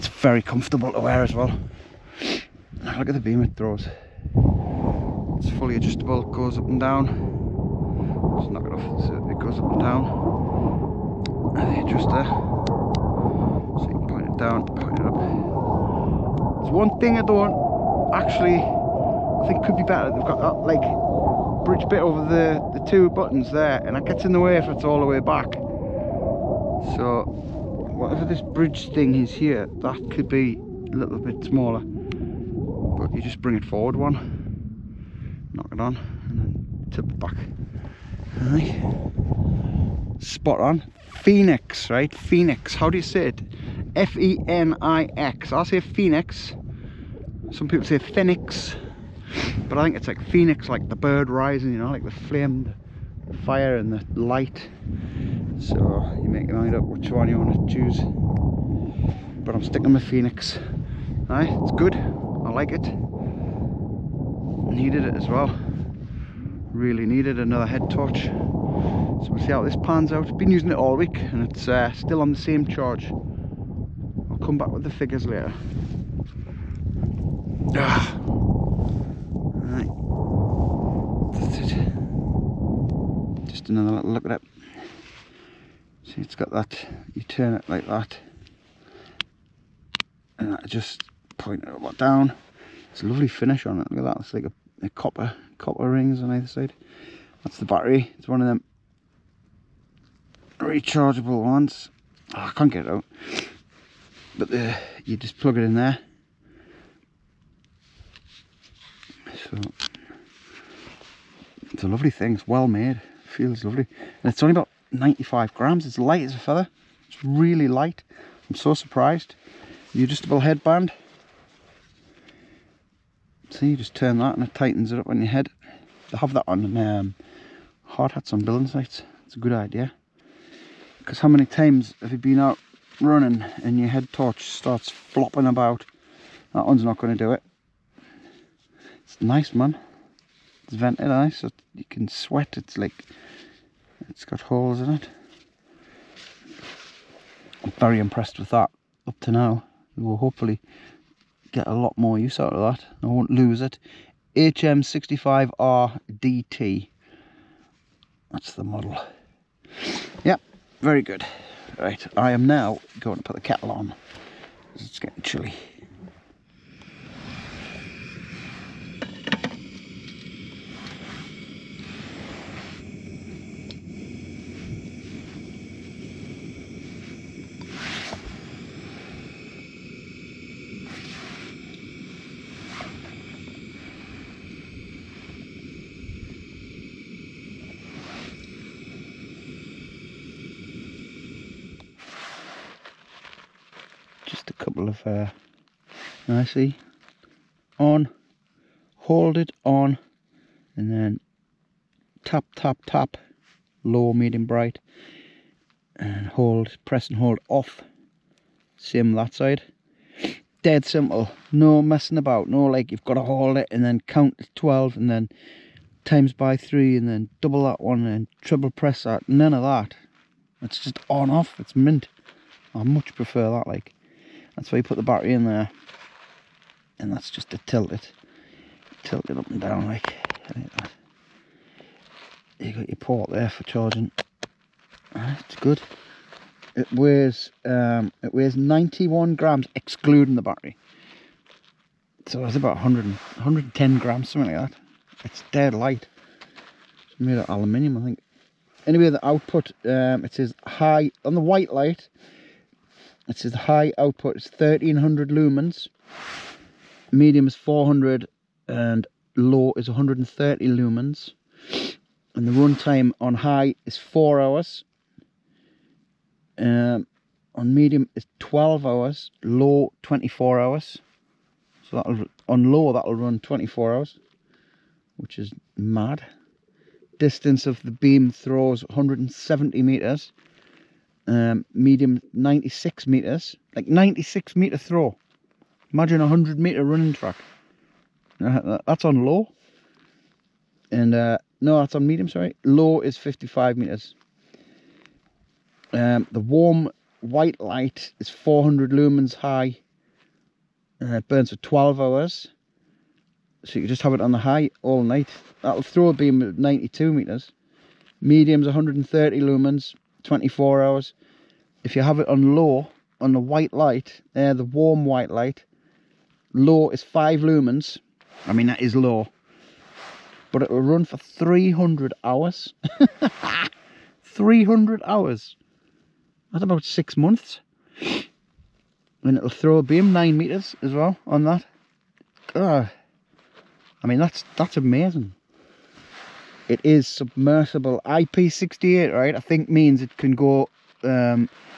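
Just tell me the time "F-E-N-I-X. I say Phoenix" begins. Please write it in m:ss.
0:43.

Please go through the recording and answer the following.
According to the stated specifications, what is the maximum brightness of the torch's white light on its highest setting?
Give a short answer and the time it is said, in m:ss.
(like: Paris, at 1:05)
1300 lumens, at 4:14.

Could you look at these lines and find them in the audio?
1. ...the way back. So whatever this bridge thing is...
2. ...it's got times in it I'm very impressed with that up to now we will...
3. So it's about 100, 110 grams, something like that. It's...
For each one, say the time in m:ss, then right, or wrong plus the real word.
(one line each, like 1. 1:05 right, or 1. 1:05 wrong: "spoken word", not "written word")
1. 0:24 right
2. 2:24 wrong: "holes", not "times"
3. 4:02 right.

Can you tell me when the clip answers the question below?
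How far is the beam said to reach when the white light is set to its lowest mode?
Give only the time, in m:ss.
4:53.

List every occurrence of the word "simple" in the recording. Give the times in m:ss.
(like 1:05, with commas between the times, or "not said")
3:30.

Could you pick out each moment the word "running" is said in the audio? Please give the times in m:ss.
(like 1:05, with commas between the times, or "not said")
2:13, 4:46.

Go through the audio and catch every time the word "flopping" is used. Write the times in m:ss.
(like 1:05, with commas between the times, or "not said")
2:14.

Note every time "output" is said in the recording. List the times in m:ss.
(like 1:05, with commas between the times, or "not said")
4:09, 4:13.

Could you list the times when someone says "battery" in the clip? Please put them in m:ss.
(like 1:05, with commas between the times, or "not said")
1:37, 3:45, 4:00.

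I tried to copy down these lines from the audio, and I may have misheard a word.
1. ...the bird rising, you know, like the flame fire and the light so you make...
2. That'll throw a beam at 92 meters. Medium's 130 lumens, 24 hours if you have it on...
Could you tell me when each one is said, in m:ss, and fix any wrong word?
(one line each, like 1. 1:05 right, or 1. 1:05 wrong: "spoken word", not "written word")
1. 0:50 right
2. 5:05 right.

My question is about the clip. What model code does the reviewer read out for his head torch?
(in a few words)
HM65RDT.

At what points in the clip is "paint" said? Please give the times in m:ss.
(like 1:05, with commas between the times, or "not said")
not said.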